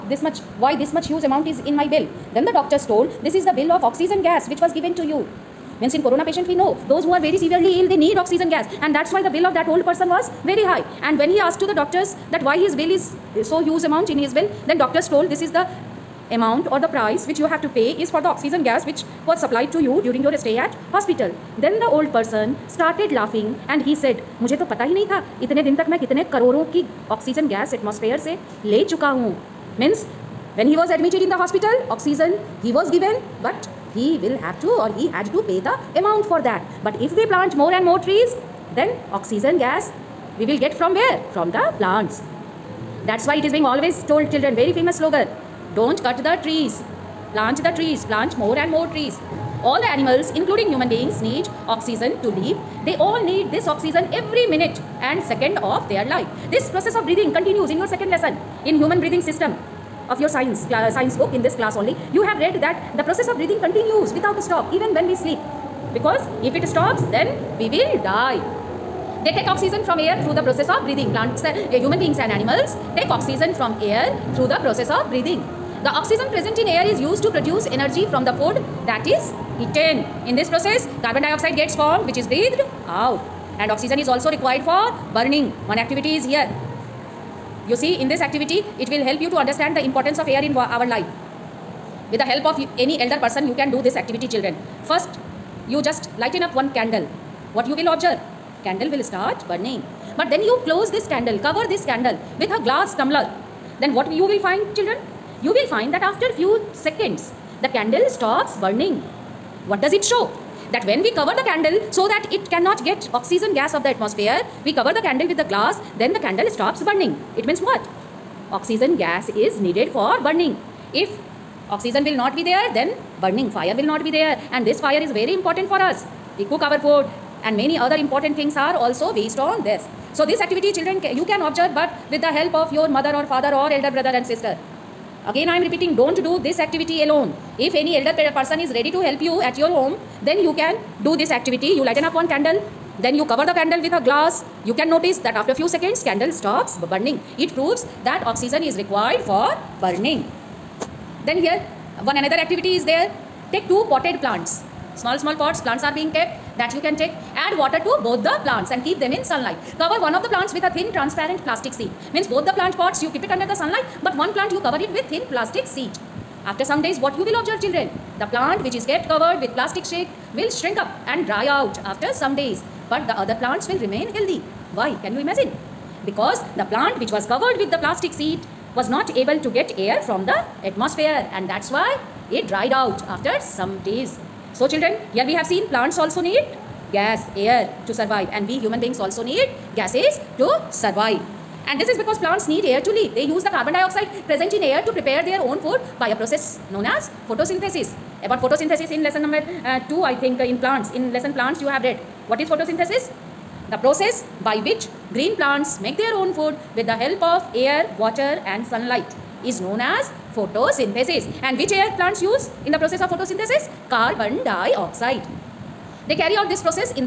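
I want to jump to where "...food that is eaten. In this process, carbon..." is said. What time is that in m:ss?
1:18.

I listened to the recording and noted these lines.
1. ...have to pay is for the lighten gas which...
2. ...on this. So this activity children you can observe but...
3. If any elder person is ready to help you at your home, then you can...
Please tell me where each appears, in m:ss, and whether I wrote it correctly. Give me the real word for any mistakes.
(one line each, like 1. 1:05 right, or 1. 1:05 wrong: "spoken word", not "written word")
1. 0:17 wrong: "oxygen", not "lighten"
2. 2:09 right
3. 2:17 right.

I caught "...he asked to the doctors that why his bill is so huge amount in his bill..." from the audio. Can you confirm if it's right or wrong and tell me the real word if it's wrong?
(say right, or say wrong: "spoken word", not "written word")
right.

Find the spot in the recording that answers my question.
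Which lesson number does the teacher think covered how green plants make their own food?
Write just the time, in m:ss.
3:19.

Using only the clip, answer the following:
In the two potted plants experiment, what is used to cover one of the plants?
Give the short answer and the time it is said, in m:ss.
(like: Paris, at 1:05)
thin transparent plastic sheet, at 2:40.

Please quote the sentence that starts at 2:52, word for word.
But the other plants will remain healthy.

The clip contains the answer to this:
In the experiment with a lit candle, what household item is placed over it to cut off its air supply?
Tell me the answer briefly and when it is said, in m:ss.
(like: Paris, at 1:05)
glass tumbler, at 1:42.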